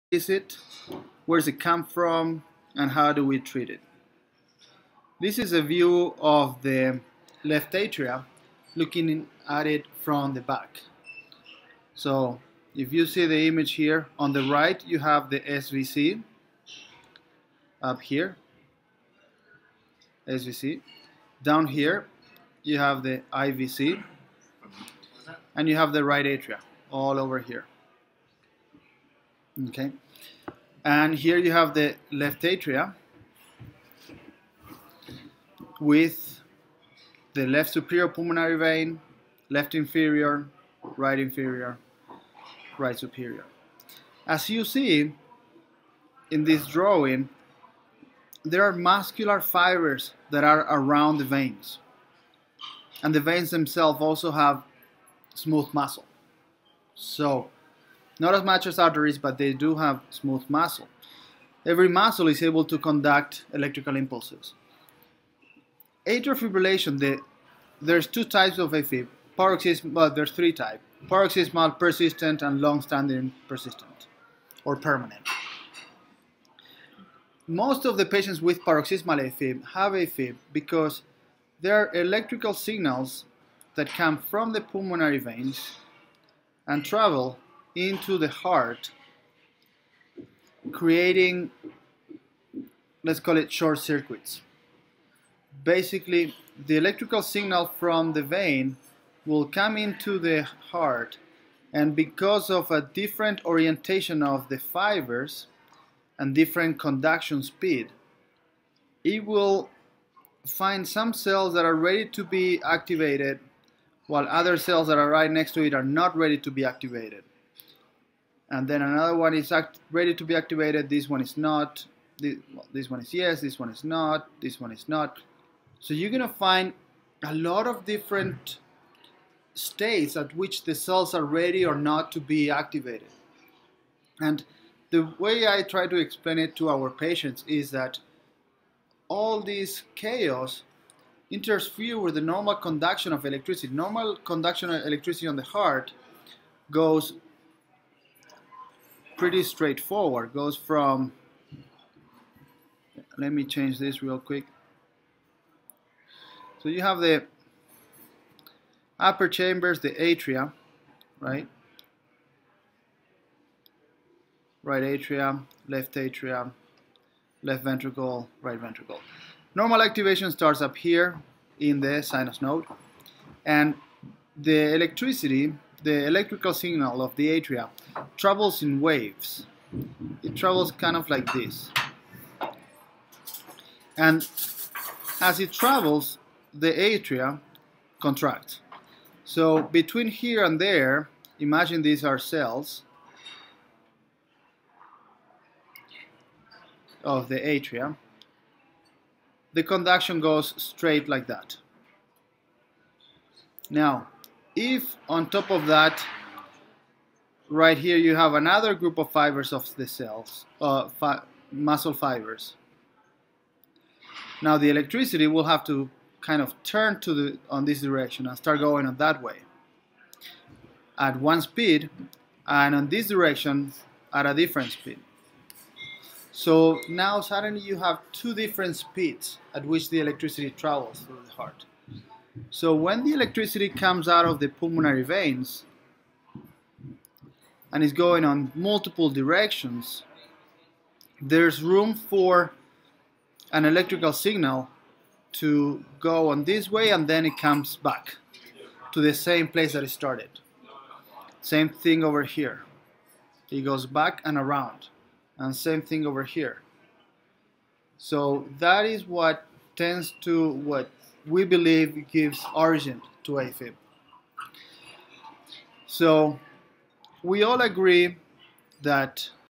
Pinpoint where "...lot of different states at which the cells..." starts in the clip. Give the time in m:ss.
2:07.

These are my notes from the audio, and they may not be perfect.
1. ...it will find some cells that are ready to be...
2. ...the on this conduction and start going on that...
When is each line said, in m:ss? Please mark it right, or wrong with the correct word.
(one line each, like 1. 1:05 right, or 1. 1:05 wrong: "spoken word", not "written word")
1. 1:49 right
2. 3:37 wrong: "direction", not "conduction".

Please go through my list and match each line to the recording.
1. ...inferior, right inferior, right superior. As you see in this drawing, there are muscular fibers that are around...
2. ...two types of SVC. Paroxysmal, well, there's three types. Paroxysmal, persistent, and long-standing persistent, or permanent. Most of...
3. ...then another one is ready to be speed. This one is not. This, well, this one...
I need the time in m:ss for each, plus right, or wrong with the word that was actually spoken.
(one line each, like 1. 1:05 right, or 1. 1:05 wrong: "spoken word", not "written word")
1. 0:39 right
2. 1:08 wrong: "AFib", not "SVC"
3. 1:58 wrong: "activated", not "speed".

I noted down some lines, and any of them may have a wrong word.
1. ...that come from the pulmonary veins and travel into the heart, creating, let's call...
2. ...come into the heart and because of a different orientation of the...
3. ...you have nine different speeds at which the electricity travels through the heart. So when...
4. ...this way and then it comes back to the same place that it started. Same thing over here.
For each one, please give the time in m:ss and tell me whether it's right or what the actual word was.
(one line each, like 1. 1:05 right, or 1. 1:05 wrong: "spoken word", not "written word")
1. 1:23 right
2. 1:39 right
3. 3:47 wrong: "two", not "nine"
4. 4:06 right.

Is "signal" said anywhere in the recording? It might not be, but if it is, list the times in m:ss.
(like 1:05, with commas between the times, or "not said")
1:22, 1:37, 2:56, 4:04.